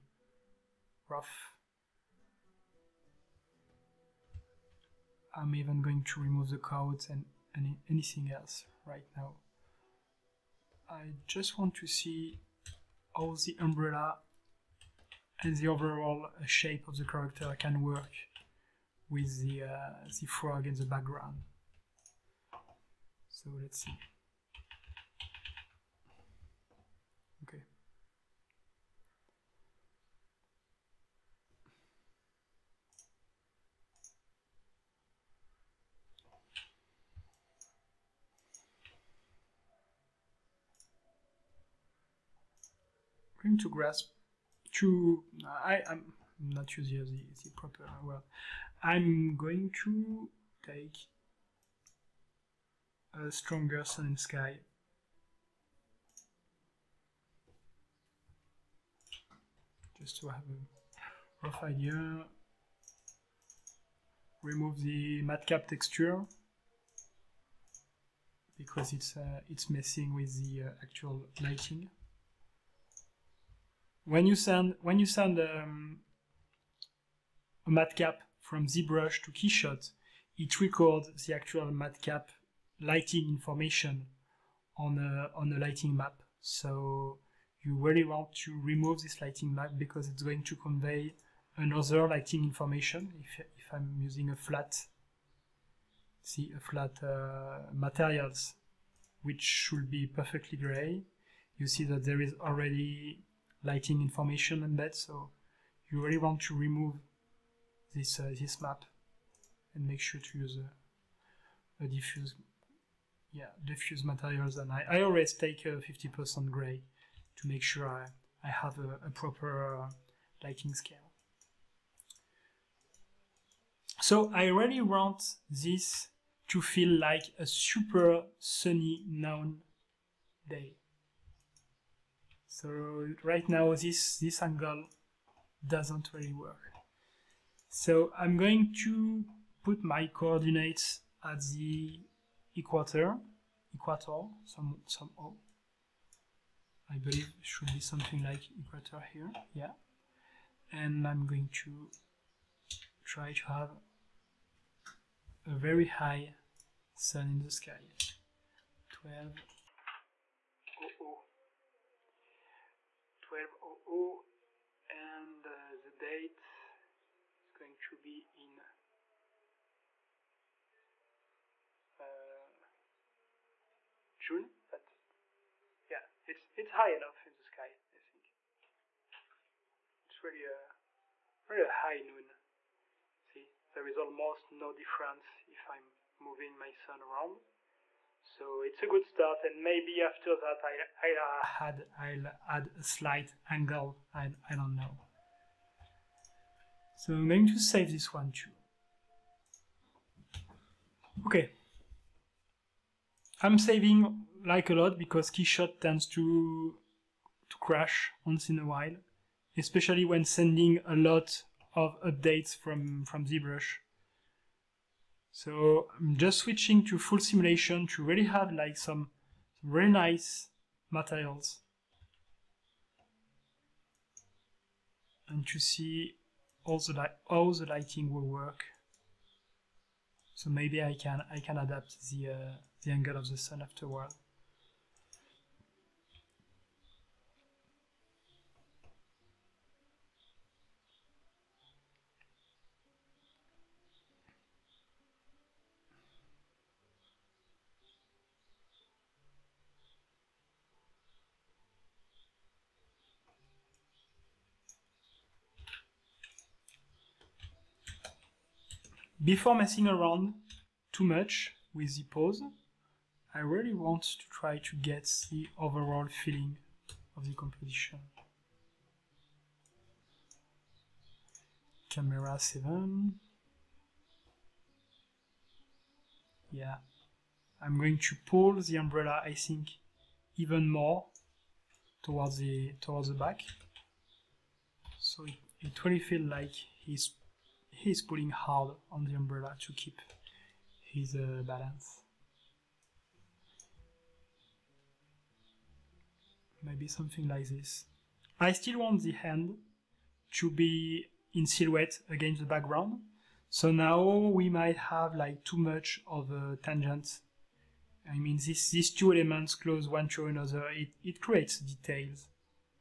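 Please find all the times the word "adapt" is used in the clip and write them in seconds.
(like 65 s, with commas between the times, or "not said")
231 s.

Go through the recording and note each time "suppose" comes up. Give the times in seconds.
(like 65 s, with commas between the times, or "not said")
not said.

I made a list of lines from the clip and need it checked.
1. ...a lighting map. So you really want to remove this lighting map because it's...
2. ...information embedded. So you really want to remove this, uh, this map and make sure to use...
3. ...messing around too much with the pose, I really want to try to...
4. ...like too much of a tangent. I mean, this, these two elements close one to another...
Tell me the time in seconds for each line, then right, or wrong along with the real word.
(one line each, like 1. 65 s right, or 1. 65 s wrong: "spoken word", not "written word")
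1. 85 s right
2. 103 s right
3. 259 s right
4. 305 s right.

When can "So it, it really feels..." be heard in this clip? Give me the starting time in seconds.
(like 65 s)
284 s.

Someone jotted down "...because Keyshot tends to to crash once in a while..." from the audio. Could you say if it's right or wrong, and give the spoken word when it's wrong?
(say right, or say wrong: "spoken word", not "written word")
right.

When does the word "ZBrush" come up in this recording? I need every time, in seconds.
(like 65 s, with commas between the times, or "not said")
78 s, 213 s.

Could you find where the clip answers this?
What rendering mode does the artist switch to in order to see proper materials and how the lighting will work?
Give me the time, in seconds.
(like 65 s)
216 s.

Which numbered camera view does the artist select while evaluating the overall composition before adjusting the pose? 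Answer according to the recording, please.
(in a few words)
Camera 7.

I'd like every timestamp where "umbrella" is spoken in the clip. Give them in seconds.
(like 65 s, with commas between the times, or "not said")
13 s, 278 s, 289 s.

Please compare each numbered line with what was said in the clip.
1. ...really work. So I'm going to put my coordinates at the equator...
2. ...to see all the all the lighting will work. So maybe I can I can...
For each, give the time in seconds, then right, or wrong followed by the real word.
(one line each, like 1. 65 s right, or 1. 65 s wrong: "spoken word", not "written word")
1. 136 s right
2. 225 s right.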